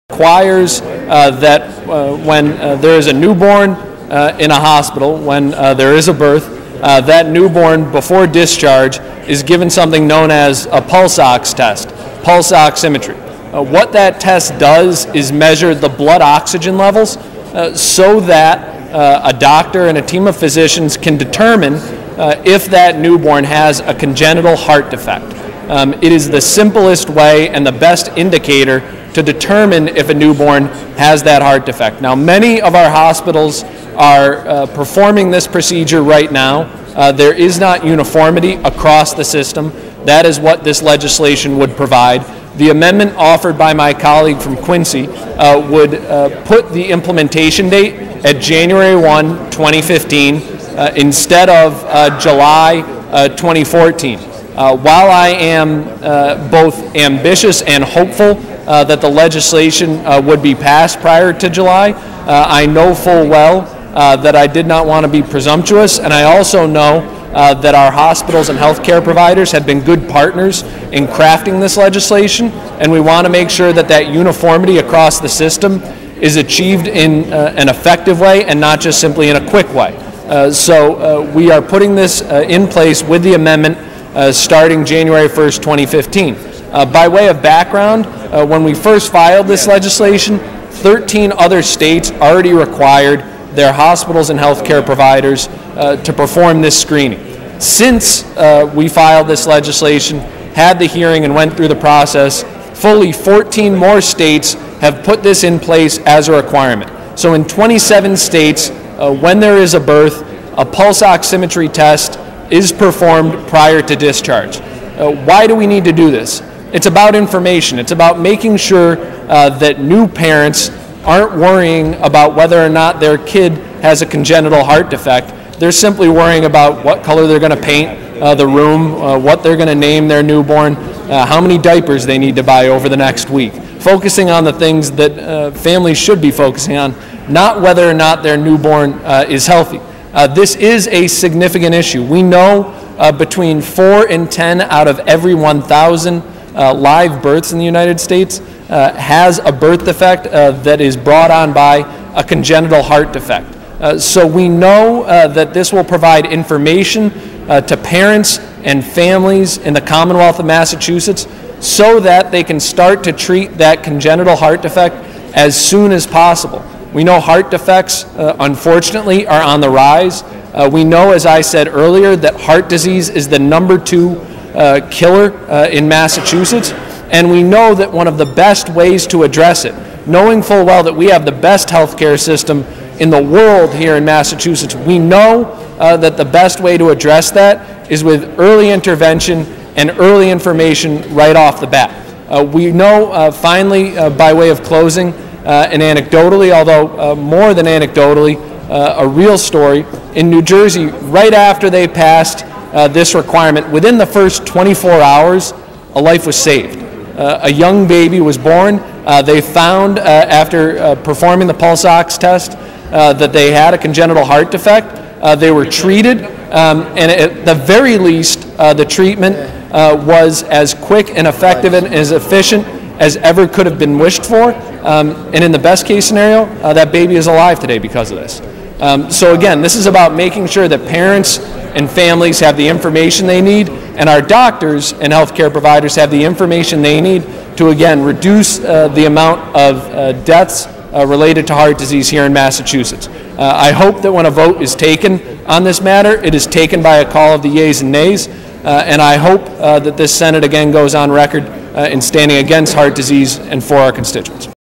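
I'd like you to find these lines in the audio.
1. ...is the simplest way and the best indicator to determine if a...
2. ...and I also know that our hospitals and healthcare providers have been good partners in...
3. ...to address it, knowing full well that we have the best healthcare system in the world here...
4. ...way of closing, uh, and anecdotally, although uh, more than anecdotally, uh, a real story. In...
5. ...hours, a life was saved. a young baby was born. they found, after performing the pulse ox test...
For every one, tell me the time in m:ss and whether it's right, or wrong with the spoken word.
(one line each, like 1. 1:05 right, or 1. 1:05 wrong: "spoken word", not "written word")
1. 0:26 right
2. 1:05 right
3. 2:59 right
4. 3:14 right
5. 3:25 right.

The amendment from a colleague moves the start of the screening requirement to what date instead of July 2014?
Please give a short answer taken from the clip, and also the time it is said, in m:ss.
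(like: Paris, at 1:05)
January 1, 2015, at 0:48.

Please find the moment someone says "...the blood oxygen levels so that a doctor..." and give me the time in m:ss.
0:15.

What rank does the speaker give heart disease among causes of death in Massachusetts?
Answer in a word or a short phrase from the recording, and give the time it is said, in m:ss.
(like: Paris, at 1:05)
number two, at 2:53.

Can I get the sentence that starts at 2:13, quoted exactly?
Focusing on the things that uh, families should be focusing on, not whether or not their newborn is healthy.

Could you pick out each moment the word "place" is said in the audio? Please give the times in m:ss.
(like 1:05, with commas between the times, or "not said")
1:22, 1:45.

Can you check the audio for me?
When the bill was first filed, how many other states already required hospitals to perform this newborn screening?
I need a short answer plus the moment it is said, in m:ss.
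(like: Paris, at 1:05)
13, at 1:30.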